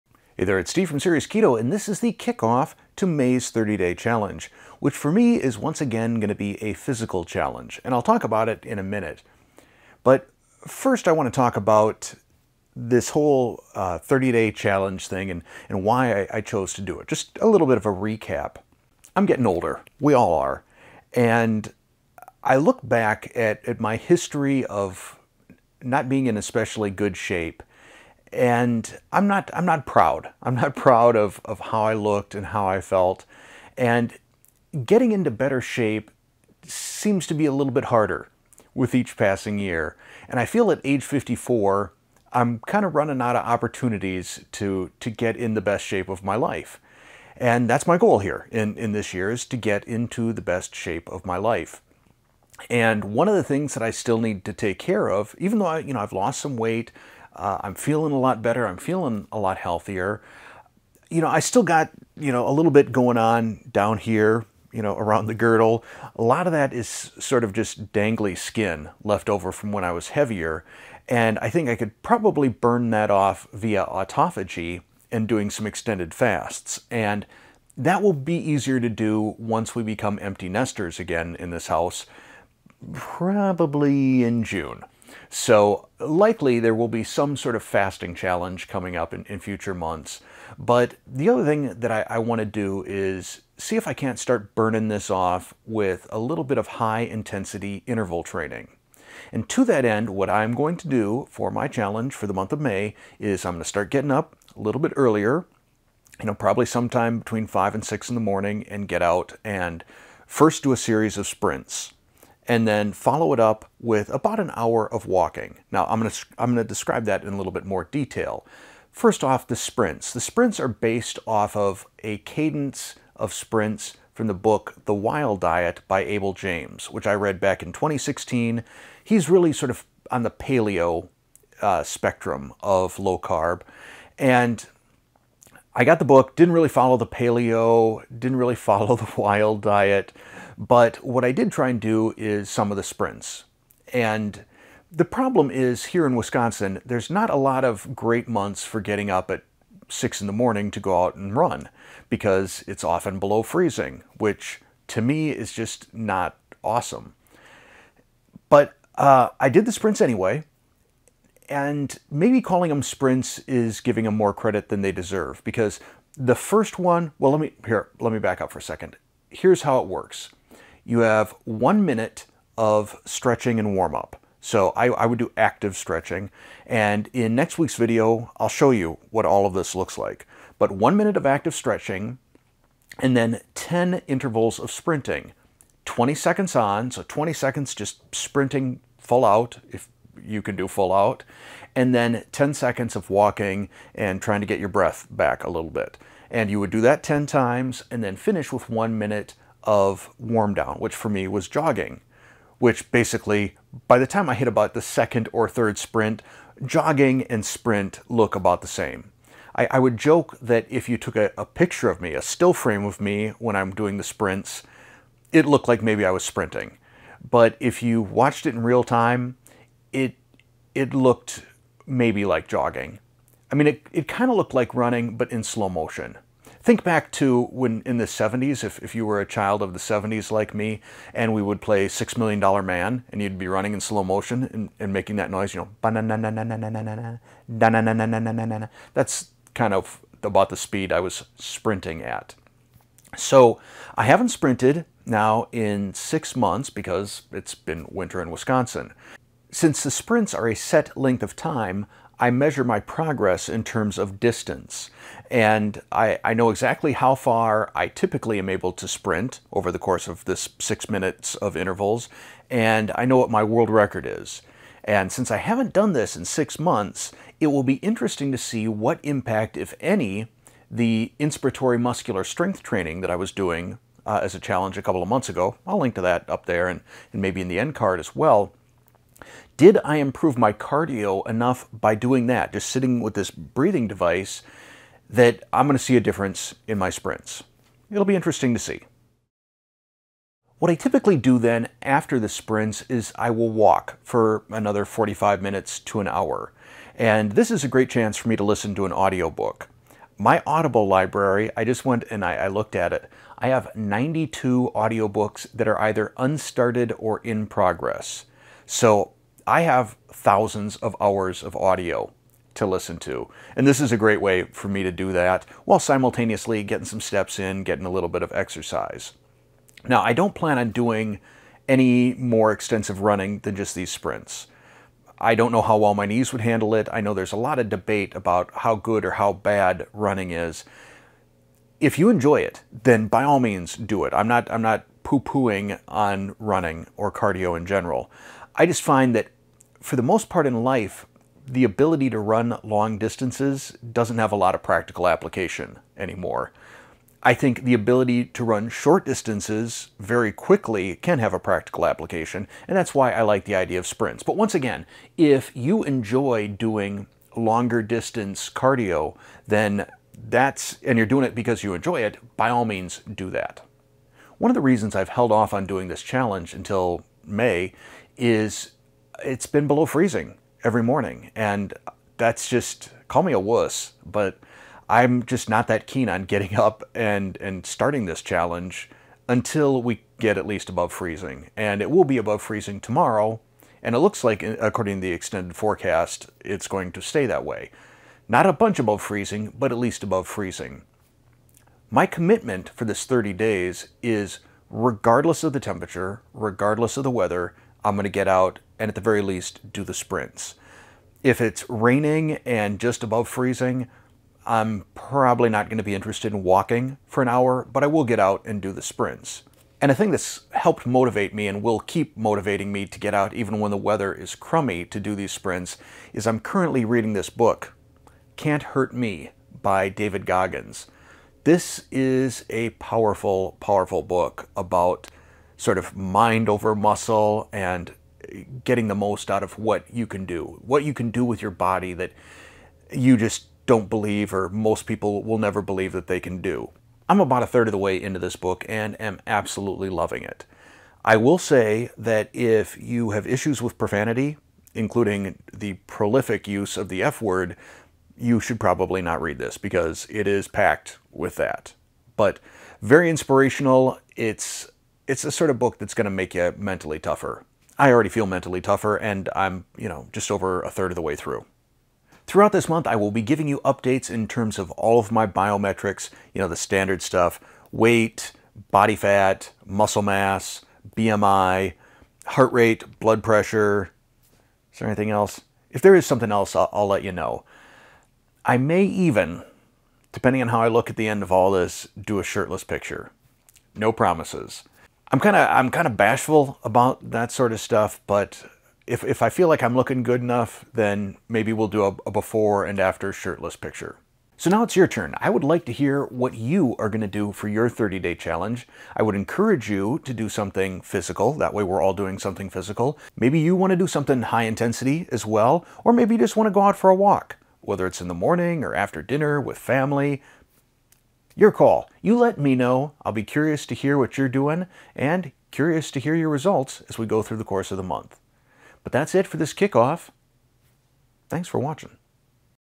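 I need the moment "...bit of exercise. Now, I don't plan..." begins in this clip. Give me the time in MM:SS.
05:18.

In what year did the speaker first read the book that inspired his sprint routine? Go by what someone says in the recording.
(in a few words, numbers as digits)
2016.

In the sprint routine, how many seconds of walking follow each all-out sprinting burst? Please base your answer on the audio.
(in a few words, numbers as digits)
10 seconds.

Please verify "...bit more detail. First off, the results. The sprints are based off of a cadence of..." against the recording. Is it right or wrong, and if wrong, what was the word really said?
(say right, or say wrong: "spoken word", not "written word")
wrong: "sprints", not "results".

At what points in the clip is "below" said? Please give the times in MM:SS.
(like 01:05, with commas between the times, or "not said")
02:33, 06:09.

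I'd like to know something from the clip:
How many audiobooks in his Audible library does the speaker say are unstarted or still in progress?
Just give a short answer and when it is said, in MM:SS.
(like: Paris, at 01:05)
92, at 05:03.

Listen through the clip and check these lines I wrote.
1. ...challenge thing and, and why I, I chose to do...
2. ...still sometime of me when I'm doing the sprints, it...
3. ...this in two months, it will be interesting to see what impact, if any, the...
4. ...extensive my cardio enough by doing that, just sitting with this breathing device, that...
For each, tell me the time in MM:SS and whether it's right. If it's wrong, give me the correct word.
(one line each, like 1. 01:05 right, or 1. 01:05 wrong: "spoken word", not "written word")
1. 00:14 right
2. 03:32 wrong: "frame", not "sometime"
3. 04:25 wrong: "six", not "two"
4. 04:39 wrong: "improve", not "extensive".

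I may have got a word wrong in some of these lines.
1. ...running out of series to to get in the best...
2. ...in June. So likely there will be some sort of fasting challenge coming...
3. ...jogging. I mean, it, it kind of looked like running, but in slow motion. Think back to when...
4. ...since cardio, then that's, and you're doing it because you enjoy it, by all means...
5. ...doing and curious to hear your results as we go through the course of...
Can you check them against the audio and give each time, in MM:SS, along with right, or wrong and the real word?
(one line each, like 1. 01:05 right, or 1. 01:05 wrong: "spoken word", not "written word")
1. 00:42 wrong: "opportunities", not "series"
2. 01:24 right
3. 03:42 right
4. 05:57 wrong: "distance", not "since"
5. 08:34 right.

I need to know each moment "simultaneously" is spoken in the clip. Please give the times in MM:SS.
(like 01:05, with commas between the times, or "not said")
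05:15.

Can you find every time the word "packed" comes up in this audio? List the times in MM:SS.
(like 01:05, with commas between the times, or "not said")
07:30.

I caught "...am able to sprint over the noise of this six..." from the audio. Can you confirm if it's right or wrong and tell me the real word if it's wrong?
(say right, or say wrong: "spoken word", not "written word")
wrong: "course", not "noise".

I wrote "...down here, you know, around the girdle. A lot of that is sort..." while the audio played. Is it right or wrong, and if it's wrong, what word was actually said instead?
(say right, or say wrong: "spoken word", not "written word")
right.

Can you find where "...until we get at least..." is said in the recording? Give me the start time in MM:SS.
06:19.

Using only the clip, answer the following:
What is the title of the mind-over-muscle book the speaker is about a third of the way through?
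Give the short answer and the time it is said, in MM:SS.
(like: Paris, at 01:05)
Can't Hurt Me, at 06:58.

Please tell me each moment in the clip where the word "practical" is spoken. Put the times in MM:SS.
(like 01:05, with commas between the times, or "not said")
05:44, 05:51.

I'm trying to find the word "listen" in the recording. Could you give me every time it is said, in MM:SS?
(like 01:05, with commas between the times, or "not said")
04:58, 05:12.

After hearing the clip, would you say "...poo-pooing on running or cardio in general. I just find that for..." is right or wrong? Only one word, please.
right.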